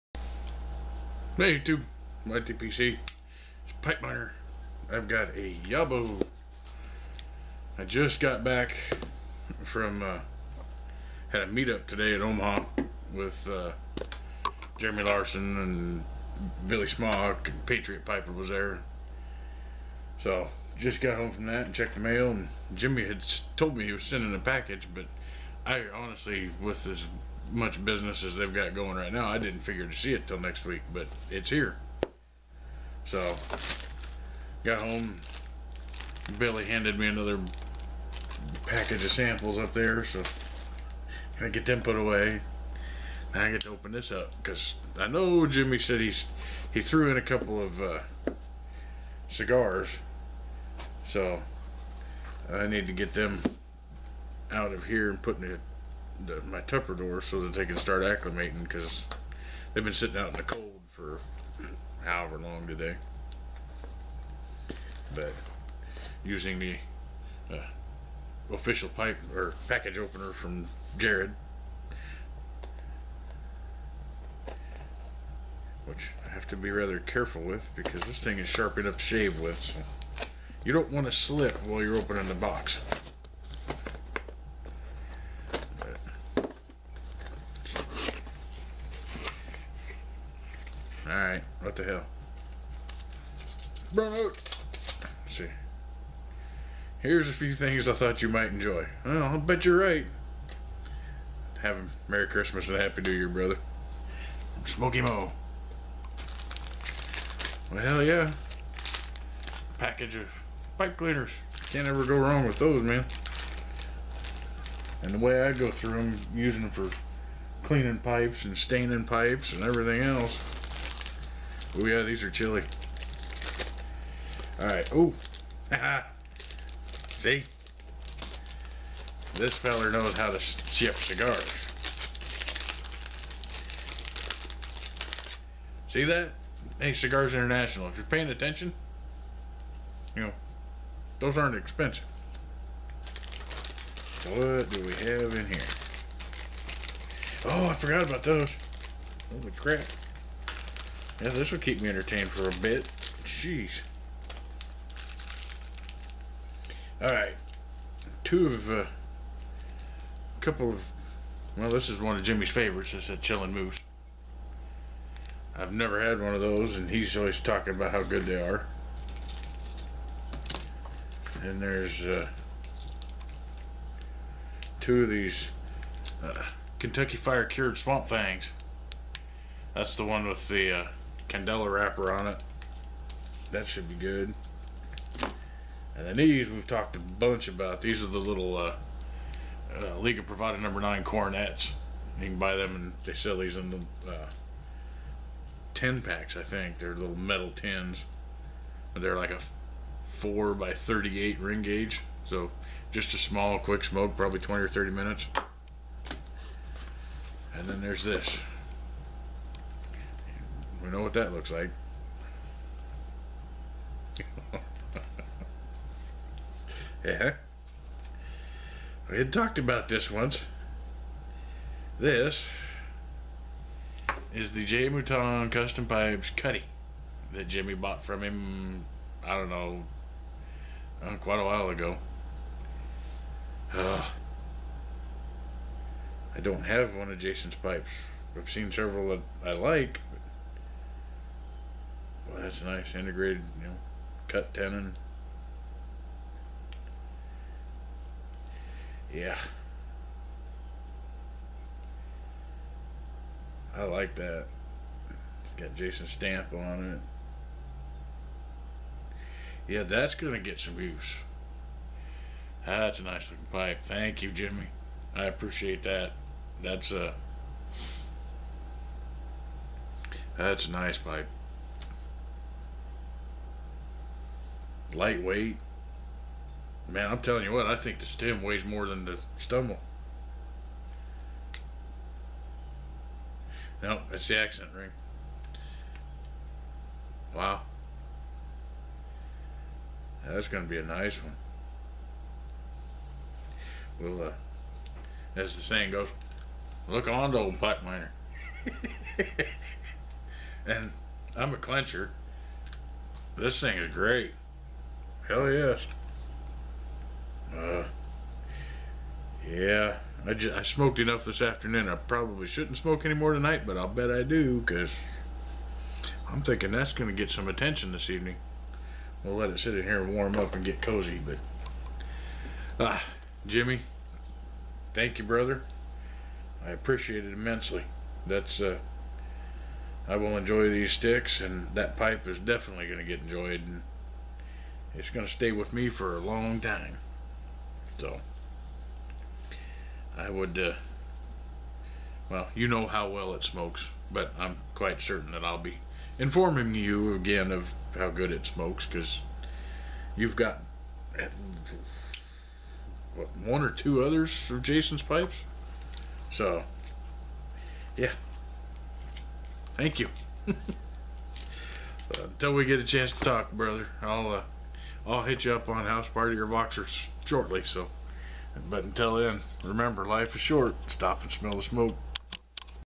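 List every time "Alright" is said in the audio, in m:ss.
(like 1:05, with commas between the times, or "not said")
1:31, 2:04, 2:36.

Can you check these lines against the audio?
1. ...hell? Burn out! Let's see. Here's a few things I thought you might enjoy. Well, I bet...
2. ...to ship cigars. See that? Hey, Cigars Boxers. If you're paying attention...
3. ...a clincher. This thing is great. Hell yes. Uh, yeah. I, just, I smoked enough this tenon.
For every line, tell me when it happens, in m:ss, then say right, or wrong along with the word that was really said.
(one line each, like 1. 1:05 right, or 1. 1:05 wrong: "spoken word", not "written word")
1. 1:31 right
2. 2:10 wrong: "International", not "Boxers"
3. 5:01 wrong: "afternoon", not "tenon".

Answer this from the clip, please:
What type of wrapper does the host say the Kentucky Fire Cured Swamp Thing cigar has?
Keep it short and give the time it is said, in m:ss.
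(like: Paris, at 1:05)
Candela, at 3:01.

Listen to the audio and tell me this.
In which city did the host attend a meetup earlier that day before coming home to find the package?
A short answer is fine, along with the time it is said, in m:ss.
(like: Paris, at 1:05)
Omaha, at 0:12.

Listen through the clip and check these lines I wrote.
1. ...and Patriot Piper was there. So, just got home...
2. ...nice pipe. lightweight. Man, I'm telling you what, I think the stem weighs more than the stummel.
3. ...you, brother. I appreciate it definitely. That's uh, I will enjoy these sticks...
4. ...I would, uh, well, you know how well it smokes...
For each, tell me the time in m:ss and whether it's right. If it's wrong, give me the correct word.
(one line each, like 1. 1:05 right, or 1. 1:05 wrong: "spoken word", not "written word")
1. 0:17 right
2. 4:30 right
3. 5:25 wrong: "immensely", not "definitely"
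4. 5:40 right.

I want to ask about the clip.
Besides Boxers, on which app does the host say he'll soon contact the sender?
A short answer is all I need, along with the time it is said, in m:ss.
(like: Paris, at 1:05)
House Party, at 6:05.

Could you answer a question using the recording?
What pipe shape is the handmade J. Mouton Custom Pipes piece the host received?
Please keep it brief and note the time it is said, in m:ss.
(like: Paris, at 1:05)
Cutty, at 3:46.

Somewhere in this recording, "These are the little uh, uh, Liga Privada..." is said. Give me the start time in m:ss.
3:07.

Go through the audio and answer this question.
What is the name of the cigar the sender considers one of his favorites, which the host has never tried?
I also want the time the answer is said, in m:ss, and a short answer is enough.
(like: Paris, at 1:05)
Chillin' Moose, at 2:43.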